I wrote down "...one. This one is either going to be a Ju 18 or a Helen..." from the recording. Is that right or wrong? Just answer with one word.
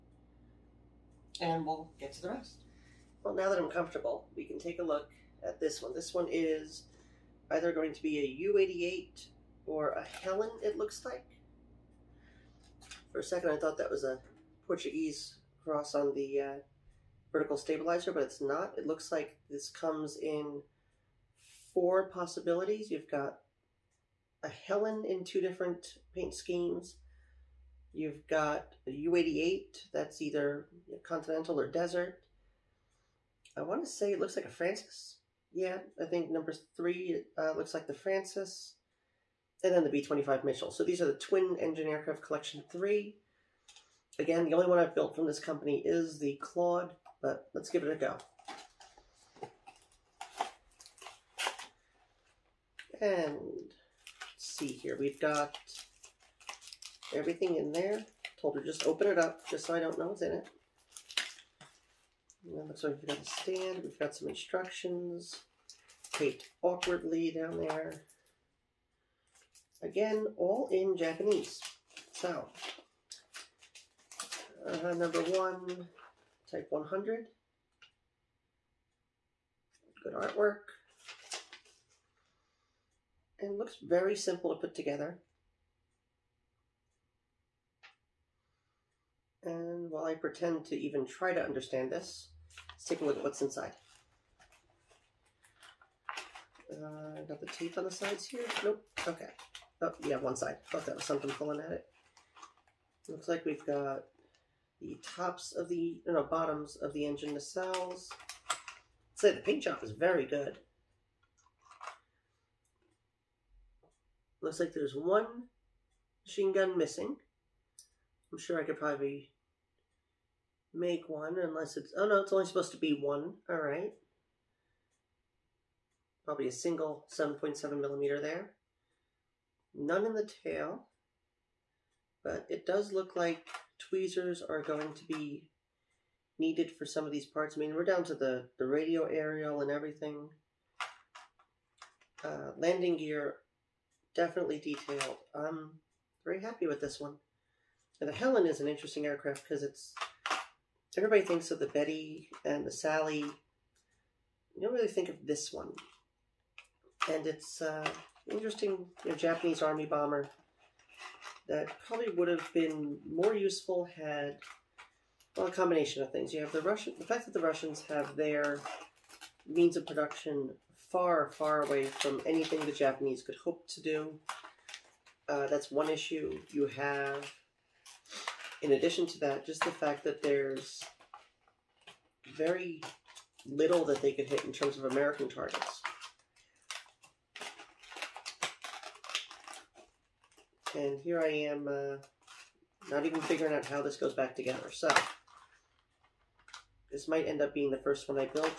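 wrong.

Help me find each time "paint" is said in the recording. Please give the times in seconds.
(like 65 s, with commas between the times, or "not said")
26 s, 109 s.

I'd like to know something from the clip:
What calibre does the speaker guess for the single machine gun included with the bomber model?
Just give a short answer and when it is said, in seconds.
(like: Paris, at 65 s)
7.7 millimeter, at 127 s.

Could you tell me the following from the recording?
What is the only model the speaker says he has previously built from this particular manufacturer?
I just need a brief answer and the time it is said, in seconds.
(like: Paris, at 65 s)
Claude, at 46 s.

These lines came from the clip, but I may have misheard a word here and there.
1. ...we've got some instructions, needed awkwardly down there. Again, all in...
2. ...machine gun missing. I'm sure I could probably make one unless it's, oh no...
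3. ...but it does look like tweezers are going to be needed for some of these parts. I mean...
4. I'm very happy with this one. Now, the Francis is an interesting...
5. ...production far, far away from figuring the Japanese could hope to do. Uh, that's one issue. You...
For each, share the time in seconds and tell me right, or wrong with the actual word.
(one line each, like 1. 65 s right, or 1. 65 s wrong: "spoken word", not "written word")
1. 63 s wrong: "taped", not "needed"
2. 116 s right
3. 132 s right
4. 145 s wrong: "Helen", not "Francis"
5. 169 s wrong: "anything", not "figuring".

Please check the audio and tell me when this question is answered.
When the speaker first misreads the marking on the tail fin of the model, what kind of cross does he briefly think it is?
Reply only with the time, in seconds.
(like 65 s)
14 s.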